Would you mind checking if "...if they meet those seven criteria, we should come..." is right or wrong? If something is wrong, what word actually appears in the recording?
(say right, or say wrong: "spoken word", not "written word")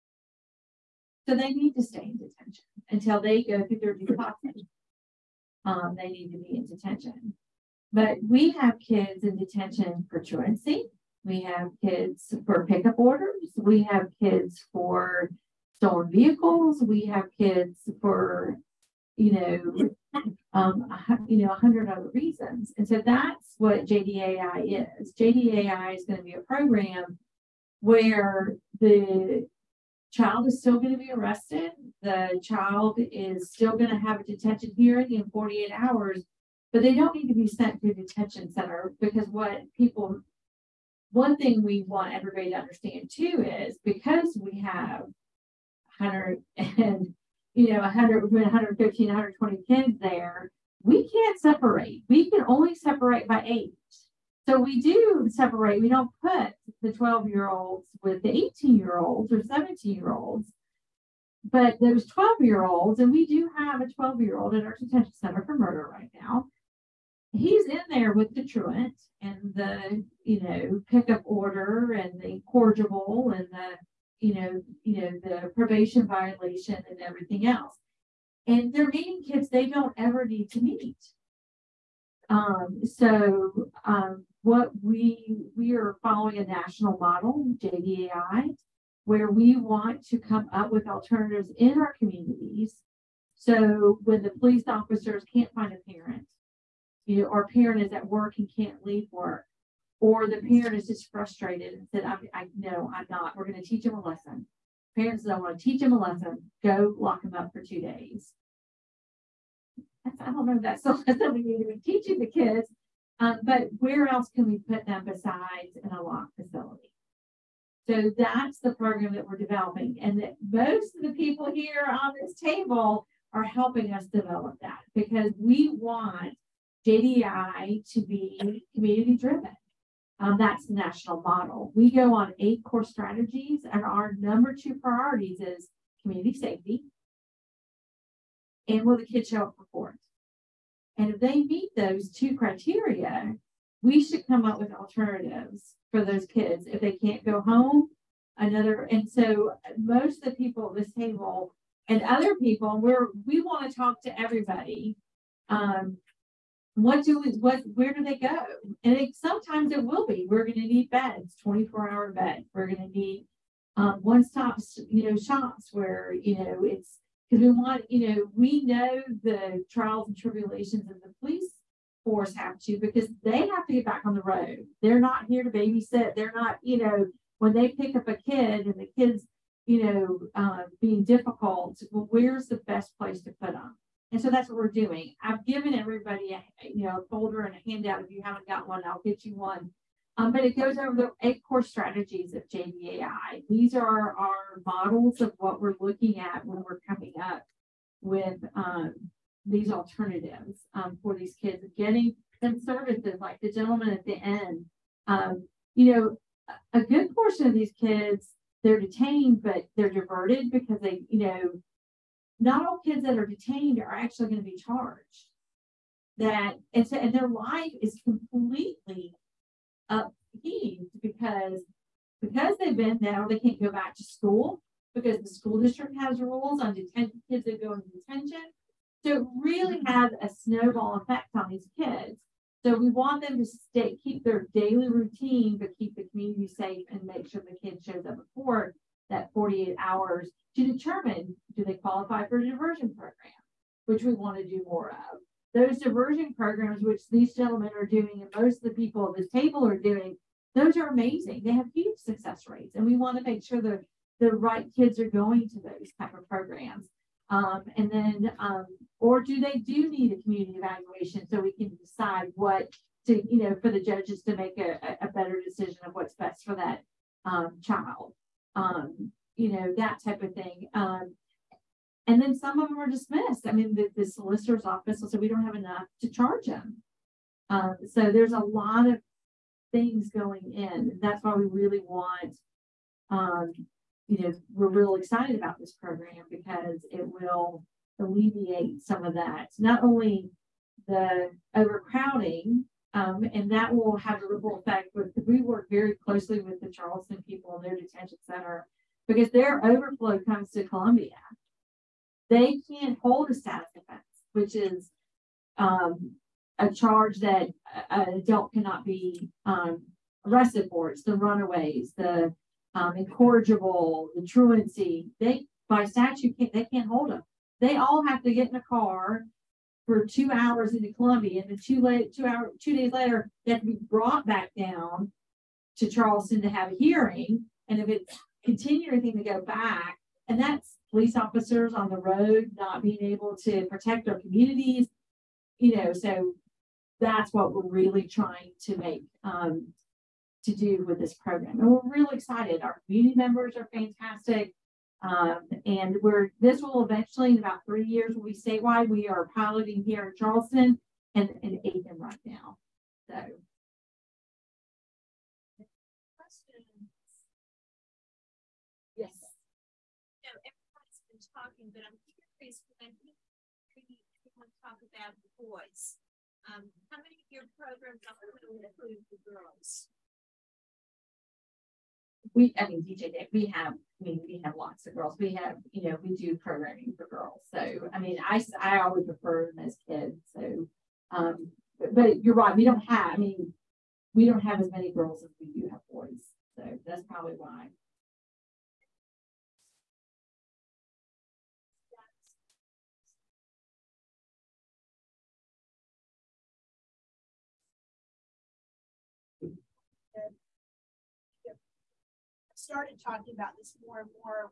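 wrong: "two", not "seven".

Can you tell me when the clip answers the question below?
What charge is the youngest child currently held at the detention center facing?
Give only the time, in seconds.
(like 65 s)
65 s.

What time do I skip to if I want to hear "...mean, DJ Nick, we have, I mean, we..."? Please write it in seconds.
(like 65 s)
372 s.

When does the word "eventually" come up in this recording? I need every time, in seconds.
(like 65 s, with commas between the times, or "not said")
346 s.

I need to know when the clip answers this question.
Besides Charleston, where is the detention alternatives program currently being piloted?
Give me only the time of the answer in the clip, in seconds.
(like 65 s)
351 s.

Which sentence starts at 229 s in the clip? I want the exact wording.
So it really has a snowball effect on these kids.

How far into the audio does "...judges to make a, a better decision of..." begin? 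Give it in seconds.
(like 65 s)
263 s.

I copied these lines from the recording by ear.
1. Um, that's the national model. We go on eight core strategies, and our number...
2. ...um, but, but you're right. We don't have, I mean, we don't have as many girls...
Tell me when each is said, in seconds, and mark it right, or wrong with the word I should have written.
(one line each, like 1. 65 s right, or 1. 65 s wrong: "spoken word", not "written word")
1. 130 s right
2. 381 s right.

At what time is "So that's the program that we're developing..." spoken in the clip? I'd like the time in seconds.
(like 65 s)
117 s.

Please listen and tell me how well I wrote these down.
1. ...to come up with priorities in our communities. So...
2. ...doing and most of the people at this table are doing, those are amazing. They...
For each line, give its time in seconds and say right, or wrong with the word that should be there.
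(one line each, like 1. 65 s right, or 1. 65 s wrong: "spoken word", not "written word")
1. 90 s wrong: "alternatives", not "priorities"
2. 247 s right.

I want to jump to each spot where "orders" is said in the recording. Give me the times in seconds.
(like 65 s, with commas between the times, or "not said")
12 s, 71 s.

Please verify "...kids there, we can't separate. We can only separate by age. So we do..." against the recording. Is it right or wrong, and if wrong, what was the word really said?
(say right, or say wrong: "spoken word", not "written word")
right.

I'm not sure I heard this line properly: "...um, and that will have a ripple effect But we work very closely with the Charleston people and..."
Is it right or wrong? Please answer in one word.
right.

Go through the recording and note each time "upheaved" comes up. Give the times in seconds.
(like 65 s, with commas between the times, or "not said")
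219 s.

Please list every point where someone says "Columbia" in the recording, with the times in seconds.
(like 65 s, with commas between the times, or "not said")
300 s, 320 s.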